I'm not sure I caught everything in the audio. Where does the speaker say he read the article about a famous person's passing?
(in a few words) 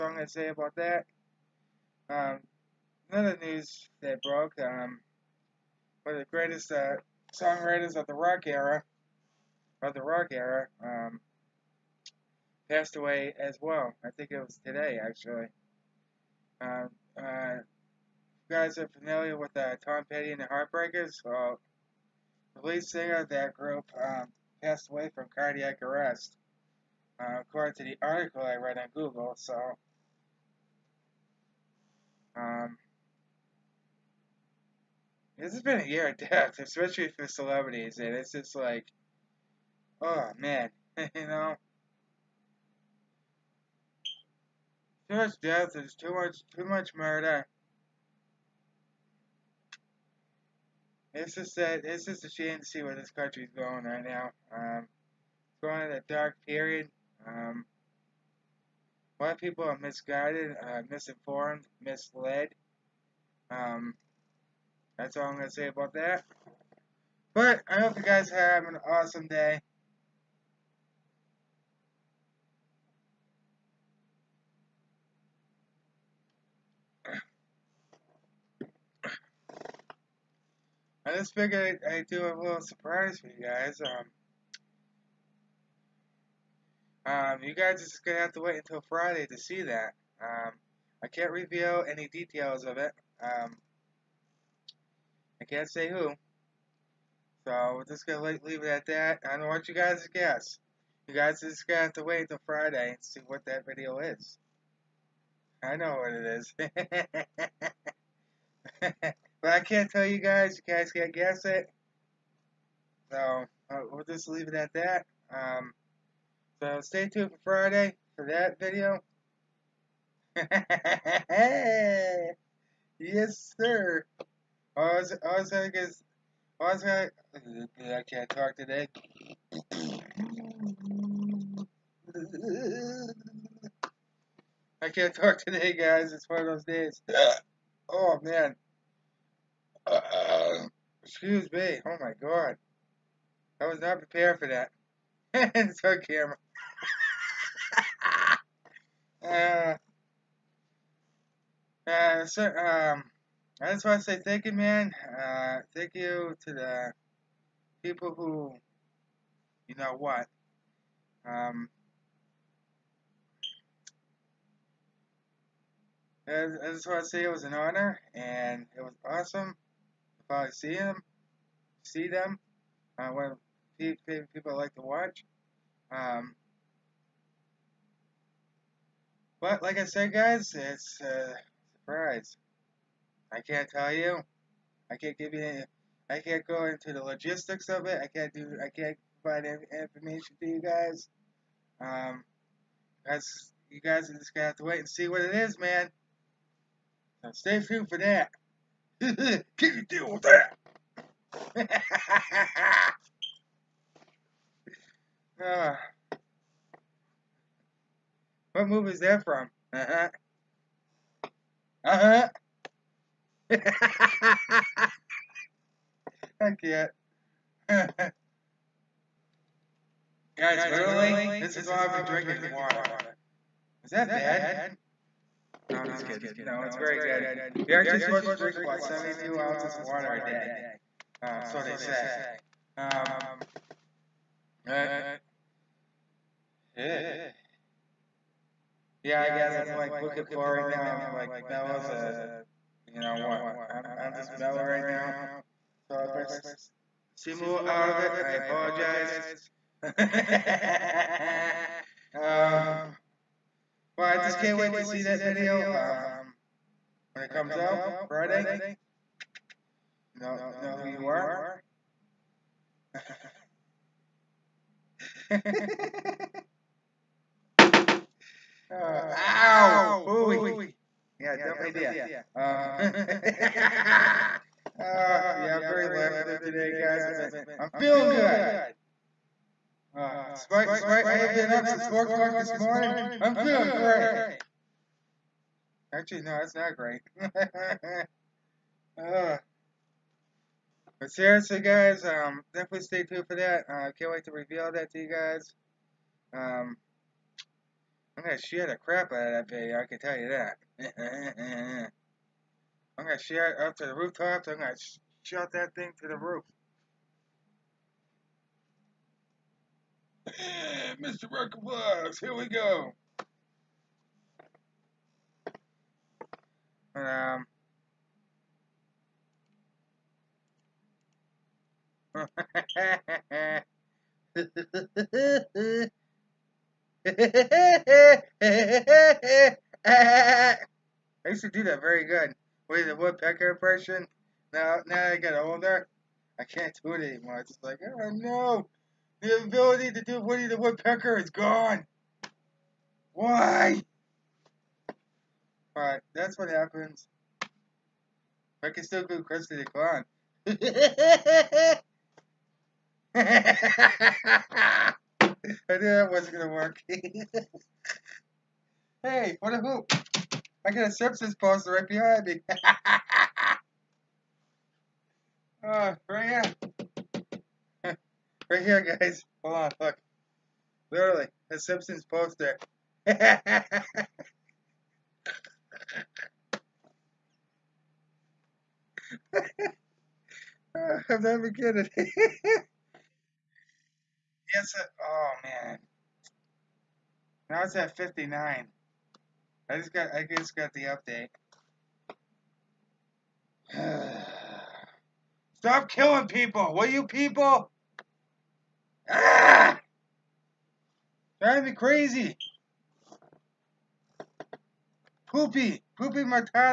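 Google.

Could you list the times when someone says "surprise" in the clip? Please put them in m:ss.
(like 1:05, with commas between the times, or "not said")
1:22, 3:01.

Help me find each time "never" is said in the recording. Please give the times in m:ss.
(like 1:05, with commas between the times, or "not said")
6:21.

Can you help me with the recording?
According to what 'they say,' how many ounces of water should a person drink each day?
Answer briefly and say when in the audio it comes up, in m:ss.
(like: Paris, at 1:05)
72 ounces, at 3:48.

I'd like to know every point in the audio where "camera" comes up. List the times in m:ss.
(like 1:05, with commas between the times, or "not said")
2:26.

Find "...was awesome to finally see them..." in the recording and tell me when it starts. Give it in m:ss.
2:48.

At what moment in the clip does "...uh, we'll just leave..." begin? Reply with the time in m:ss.
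1:53.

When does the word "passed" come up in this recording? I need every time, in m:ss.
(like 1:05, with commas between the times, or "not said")
0:12, 0:24.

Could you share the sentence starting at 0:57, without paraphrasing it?
Um, a lot of people are misguided, uh, misinformed, misled.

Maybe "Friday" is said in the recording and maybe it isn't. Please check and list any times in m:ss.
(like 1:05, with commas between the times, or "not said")
1:28, 1:42, 1:57, 4:18.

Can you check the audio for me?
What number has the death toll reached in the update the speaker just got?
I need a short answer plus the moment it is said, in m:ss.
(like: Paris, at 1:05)
59, at 6:27.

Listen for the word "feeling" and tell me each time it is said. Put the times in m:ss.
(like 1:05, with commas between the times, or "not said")
4:37, 4:43.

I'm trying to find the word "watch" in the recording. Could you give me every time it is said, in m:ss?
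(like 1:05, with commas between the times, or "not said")
2:54.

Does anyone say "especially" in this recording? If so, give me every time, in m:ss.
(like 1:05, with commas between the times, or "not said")
0:36.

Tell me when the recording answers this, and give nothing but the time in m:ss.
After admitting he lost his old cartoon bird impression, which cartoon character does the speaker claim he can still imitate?
5:49.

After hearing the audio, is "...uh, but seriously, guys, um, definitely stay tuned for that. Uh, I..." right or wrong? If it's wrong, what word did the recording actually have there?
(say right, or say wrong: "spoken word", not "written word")
right.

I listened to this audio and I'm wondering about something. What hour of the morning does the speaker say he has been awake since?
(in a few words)
4 o'clock.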